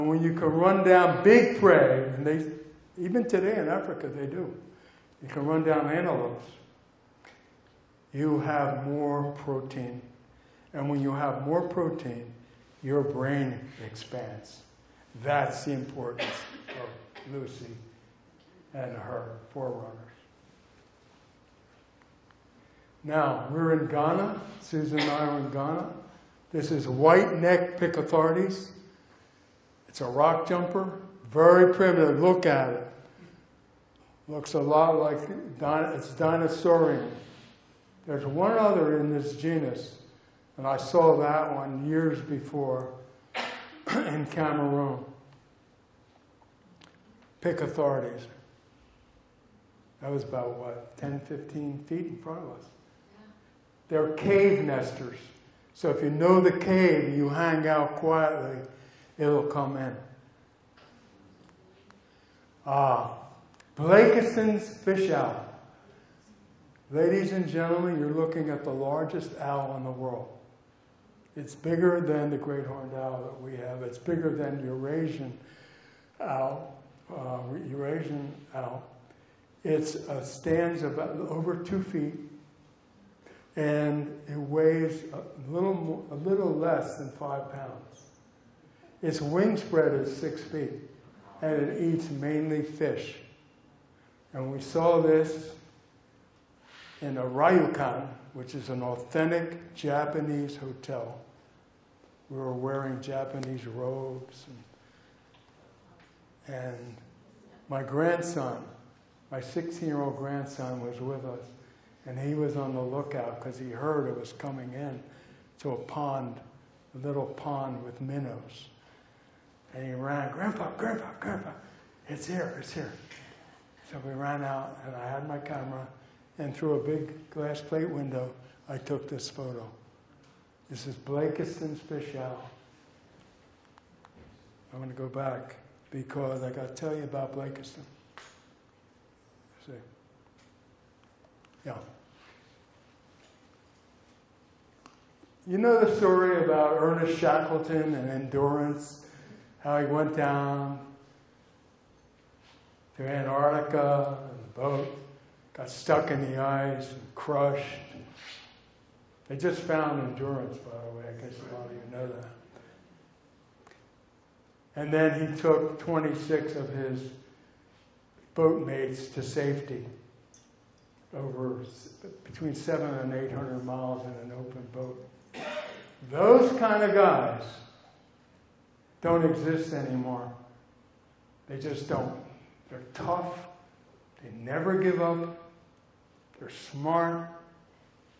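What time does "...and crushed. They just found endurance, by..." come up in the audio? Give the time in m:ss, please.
2:36.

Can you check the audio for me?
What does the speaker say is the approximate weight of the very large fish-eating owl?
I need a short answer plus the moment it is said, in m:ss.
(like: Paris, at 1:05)
a little less than 5 pounds, at 1:26.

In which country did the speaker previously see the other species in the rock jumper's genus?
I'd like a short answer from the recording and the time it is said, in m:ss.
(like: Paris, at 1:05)
Cameroon, at 0:44.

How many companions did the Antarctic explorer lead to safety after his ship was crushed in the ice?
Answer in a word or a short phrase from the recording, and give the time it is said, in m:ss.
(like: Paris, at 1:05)
26, at 2:45.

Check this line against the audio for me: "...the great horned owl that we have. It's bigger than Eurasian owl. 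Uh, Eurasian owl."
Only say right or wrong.
right.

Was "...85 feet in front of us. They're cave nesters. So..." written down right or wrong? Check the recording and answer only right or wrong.
wrong.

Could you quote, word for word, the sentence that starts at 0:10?
And when you have more protein, your brain expands.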